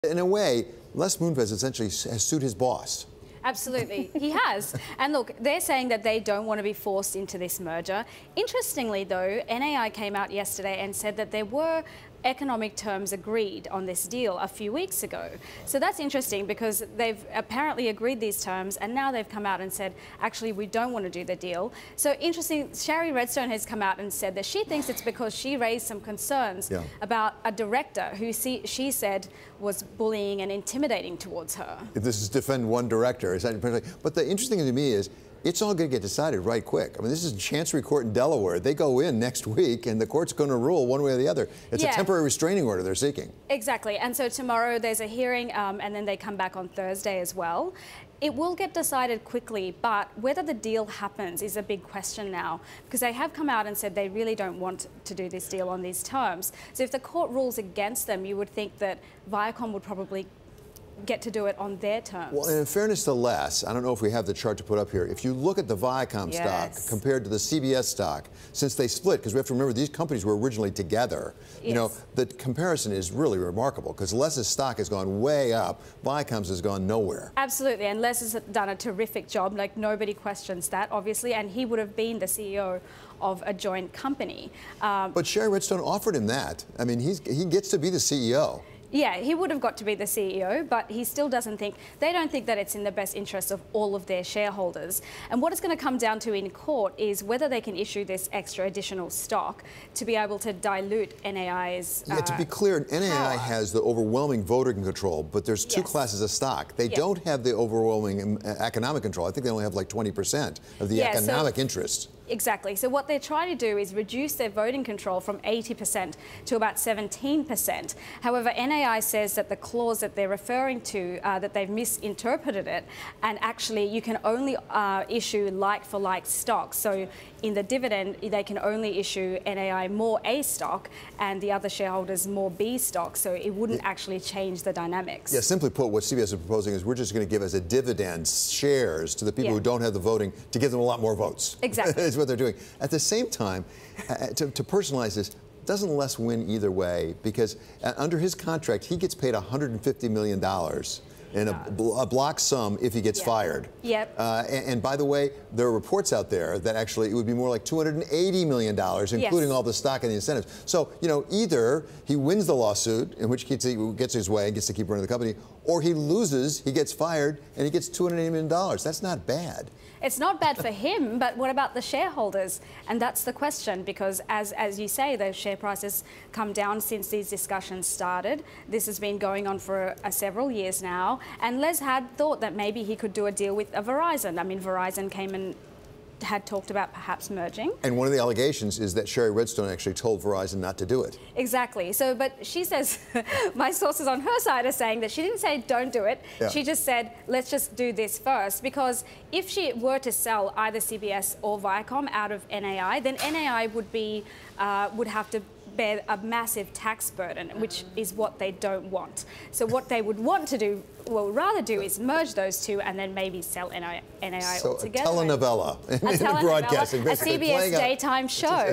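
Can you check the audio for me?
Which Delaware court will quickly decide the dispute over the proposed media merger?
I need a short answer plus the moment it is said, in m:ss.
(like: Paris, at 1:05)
Chancery Court, at 0:37.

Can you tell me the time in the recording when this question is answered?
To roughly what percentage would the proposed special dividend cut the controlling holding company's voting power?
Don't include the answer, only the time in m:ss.
1:56.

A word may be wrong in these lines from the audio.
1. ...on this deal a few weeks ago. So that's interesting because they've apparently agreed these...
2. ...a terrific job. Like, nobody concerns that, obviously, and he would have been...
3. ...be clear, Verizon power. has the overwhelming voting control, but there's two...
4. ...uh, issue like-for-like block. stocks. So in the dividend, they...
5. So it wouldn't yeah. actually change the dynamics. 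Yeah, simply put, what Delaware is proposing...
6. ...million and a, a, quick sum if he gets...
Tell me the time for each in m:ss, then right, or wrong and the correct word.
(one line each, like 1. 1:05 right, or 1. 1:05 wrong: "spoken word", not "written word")
1. 0:13 right
2. 1:18 wrong: "questions", not "concerns"
3. 1:42 wrong: "NAI", not "Verizon"
4. 2:04 wrong: "stock", not "block"
5. 2:13 wrong: "CBS", not "Delaware"
6. 2:30 wrong: "block", not "quick".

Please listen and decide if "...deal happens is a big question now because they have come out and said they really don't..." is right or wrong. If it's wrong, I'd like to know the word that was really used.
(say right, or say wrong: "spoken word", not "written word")
right.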